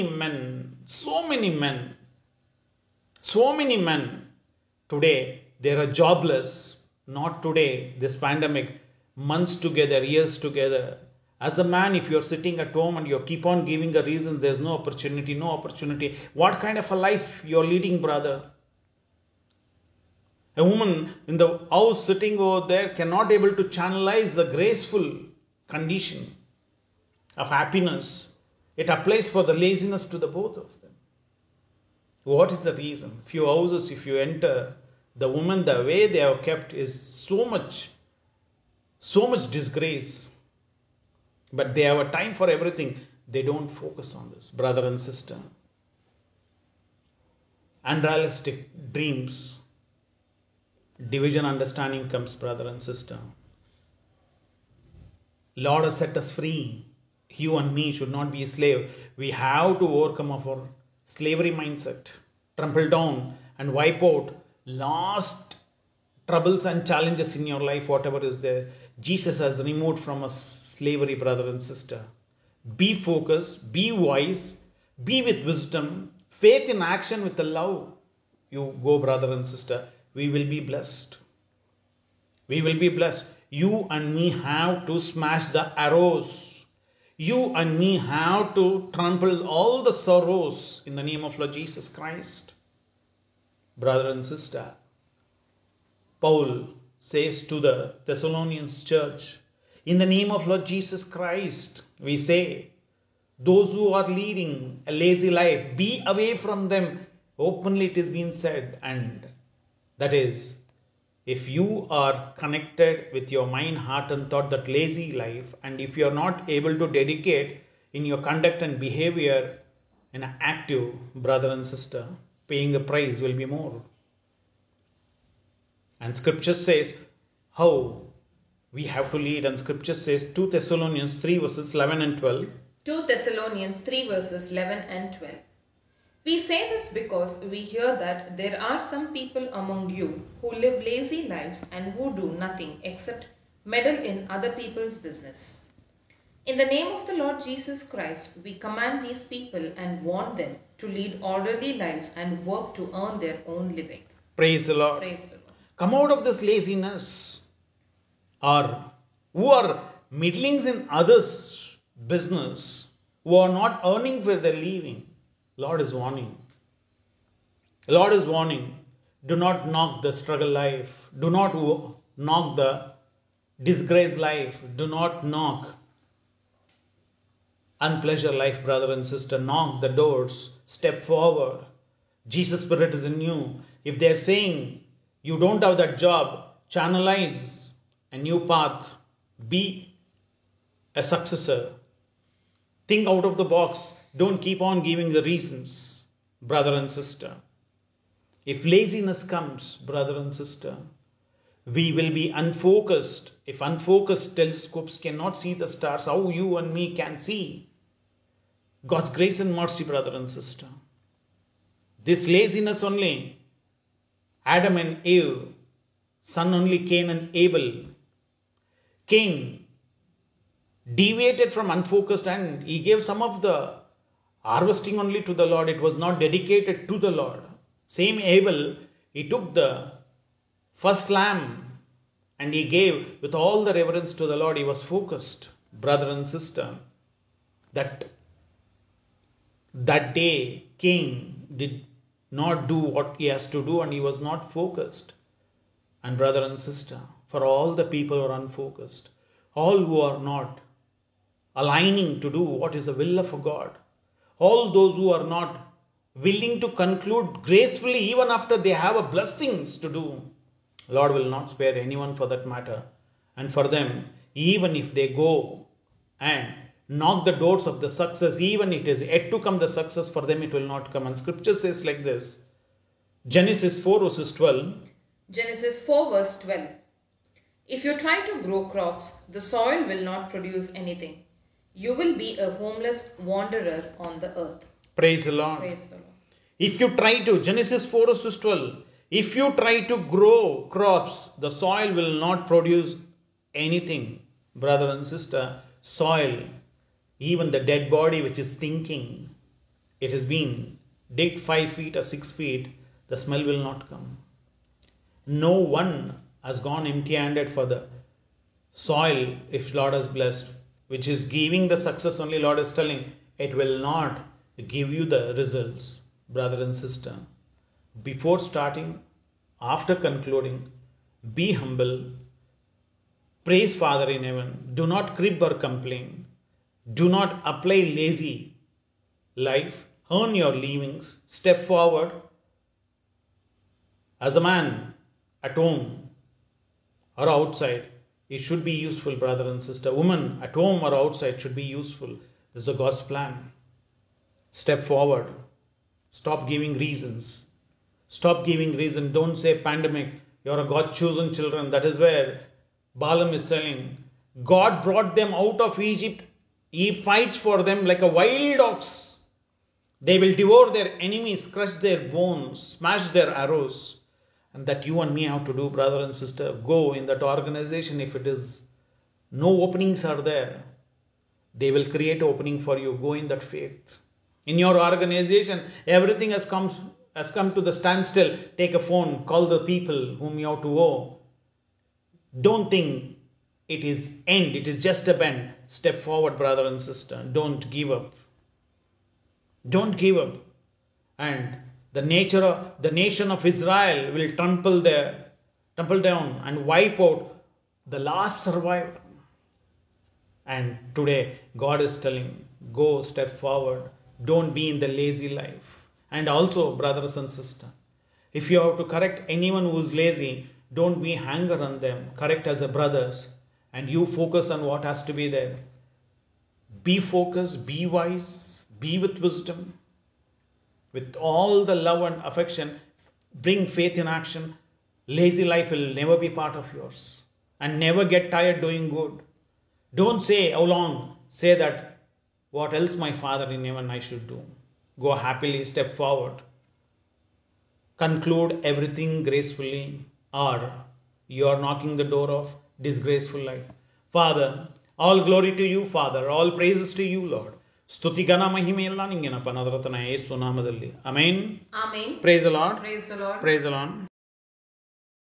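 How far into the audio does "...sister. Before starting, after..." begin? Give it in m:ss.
5:16.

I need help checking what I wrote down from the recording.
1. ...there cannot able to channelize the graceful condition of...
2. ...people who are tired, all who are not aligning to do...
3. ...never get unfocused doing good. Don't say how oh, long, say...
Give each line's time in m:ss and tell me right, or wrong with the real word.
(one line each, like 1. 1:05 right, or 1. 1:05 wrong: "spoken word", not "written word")
1. 0:22 right
2. 4:07 wrong: "unfocused", not "tired"
3. 7:07 wrong: "tired", not "unfocused".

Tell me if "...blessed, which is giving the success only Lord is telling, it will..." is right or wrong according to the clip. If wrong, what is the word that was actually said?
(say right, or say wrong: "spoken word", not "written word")
right.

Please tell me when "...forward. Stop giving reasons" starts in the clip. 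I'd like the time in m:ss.
5:44.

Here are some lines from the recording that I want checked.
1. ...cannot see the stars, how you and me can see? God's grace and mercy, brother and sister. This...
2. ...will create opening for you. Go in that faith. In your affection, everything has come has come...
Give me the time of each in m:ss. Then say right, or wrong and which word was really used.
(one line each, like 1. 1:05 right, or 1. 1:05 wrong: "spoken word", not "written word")
1. 3:24 right
2. 6:11 wrong: "organization", not "affection".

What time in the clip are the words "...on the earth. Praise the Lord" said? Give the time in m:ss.
4:43.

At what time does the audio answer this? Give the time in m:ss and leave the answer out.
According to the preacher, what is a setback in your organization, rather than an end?
6:25.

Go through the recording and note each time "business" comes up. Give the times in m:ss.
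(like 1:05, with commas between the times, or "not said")
2:24, 2:42.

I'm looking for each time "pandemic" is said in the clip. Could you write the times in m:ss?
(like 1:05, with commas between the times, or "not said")
0:08, 5:49.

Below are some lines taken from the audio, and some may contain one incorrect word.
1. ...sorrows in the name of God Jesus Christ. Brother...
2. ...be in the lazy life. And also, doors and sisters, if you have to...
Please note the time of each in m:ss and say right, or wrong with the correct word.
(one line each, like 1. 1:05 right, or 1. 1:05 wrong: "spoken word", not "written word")
1. 1:29 wrong: "Lord", not "God"
2. 6:44 wrong: "brothers", not "doors".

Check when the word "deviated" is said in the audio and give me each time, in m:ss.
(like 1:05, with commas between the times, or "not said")
3:40.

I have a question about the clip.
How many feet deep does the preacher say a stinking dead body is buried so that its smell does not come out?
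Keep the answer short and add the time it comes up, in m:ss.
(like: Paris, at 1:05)
5 or 6 feet, at 5:01.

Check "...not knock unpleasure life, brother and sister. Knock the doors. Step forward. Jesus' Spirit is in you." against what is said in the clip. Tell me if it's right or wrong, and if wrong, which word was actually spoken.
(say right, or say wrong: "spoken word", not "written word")
right.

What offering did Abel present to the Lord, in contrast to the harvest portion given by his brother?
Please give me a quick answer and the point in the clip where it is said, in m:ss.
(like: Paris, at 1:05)
the first lamb, at 3:49.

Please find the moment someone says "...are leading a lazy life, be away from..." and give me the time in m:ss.
1:43.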